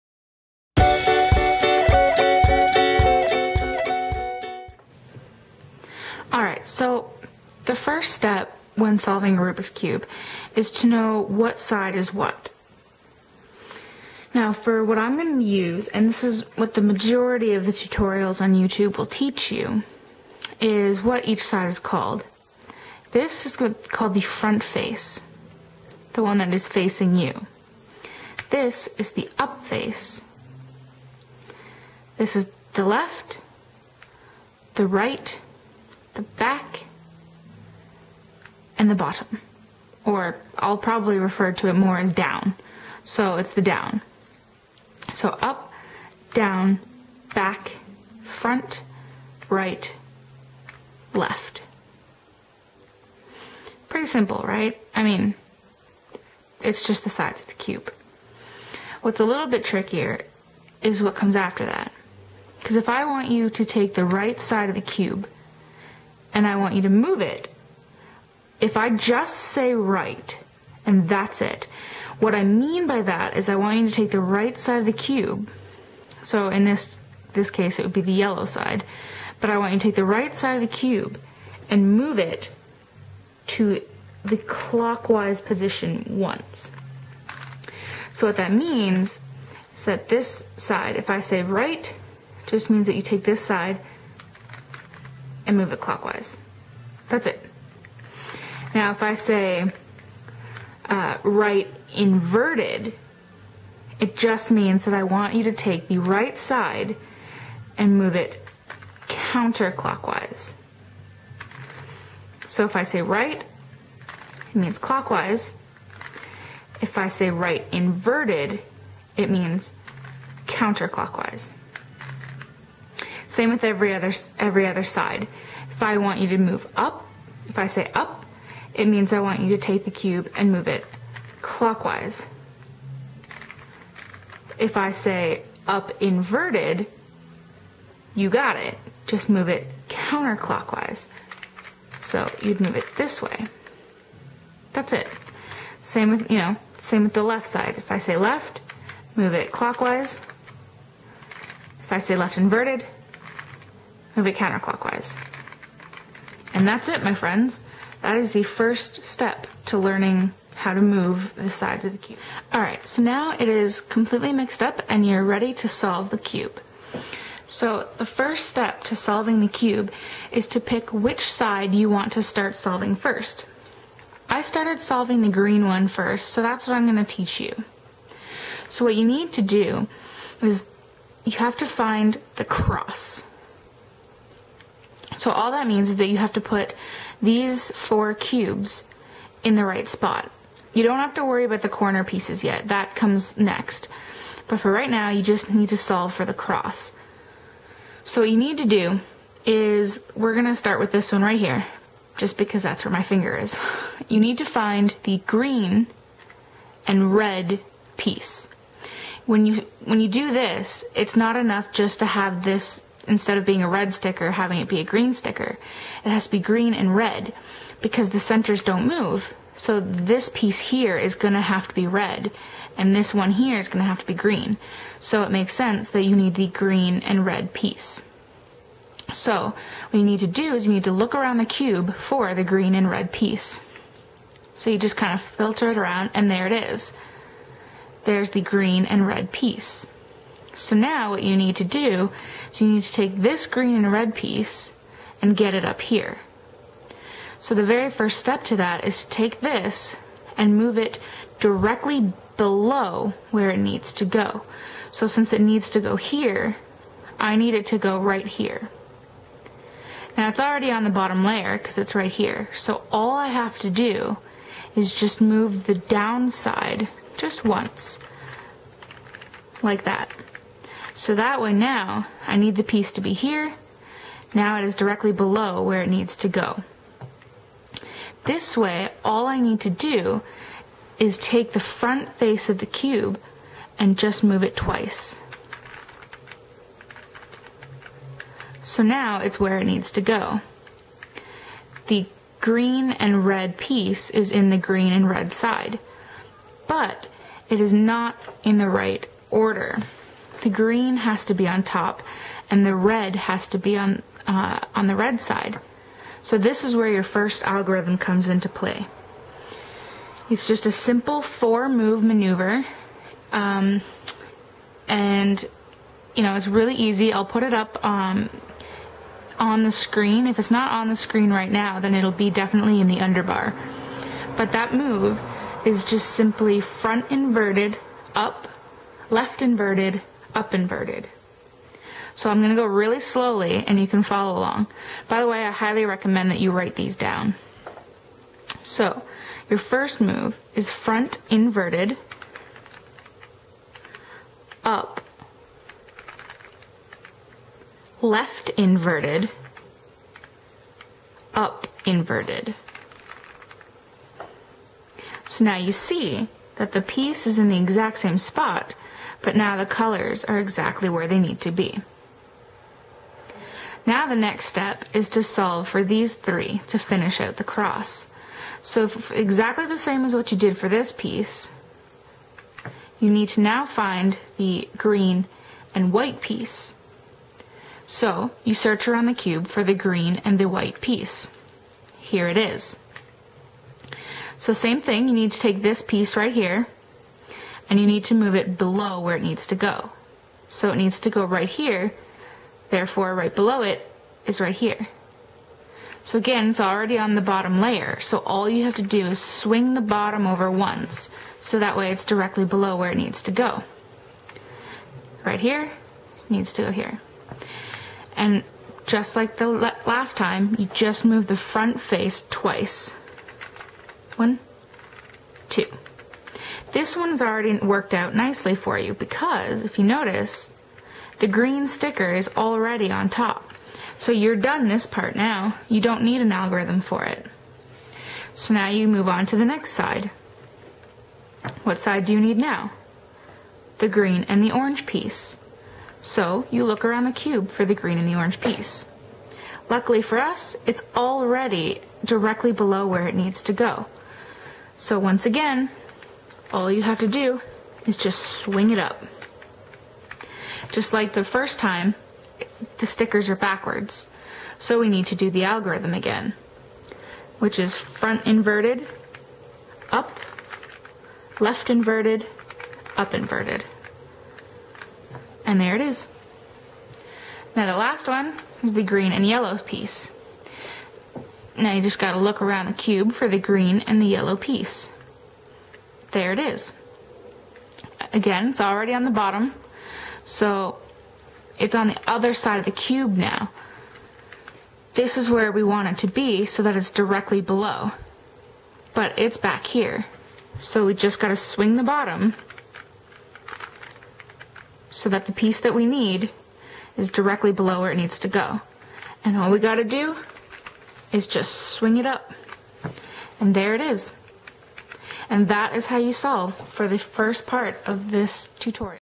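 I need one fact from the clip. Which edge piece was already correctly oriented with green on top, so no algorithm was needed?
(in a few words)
Green and white.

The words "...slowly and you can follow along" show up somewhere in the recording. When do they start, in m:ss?
5:32.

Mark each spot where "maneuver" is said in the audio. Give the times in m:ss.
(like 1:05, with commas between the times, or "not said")
5:12.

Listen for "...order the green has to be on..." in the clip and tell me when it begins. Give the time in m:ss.
4:59.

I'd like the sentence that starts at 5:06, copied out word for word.
So this is where your first algorithm comes into play.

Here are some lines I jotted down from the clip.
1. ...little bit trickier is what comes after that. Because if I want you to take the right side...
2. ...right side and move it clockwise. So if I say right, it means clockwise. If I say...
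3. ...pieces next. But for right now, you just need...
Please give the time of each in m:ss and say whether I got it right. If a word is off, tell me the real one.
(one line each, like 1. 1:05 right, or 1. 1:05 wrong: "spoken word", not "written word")
1. 0:59 right
2. 1:45 wrong: "counterclockwise", not "clockwise"
3. 3:12 wrong: "comes", not "pieces".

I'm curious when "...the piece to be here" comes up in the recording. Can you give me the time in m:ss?
4:32.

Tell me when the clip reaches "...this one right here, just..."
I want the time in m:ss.
3:20.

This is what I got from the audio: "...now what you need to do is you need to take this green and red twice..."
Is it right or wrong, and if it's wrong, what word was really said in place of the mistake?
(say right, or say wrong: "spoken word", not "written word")
wrong: "piece", not "twice".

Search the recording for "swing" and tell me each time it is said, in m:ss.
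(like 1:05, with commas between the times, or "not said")
6:39, 7:28, 8:11, 8:21.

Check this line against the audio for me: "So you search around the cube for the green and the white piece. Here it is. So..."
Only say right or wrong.
right.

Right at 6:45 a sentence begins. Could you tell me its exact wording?
Right here, needs to go here.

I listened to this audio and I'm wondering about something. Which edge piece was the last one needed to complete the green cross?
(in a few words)
Green and yellow.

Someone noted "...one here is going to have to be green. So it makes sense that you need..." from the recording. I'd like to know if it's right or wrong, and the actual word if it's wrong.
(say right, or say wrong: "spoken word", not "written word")
right.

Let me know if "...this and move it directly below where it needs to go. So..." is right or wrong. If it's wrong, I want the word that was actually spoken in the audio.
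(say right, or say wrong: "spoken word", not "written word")
right.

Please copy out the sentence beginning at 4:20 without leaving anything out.
Now it's already on the bottom layer because it's right here.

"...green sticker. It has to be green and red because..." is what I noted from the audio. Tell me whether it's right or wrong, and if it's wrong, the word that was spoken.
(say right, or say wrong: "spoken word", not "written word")
right.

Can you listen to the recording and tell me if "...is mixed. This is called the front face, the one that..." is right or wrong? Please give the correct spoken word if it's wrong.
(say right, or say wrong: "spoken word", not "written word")
wrong: "called", not "mixed".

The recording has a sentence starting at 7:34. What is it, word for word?
So we need to do the algorithm again, which is front inverted, up, left inverted, up inverted.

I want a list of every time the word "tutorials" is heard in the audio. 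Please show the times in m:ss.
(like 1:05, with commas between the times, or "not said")
0:17, 8:28.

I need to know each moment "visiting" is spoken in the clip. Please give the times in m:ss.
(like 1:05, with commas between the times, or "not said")
not said.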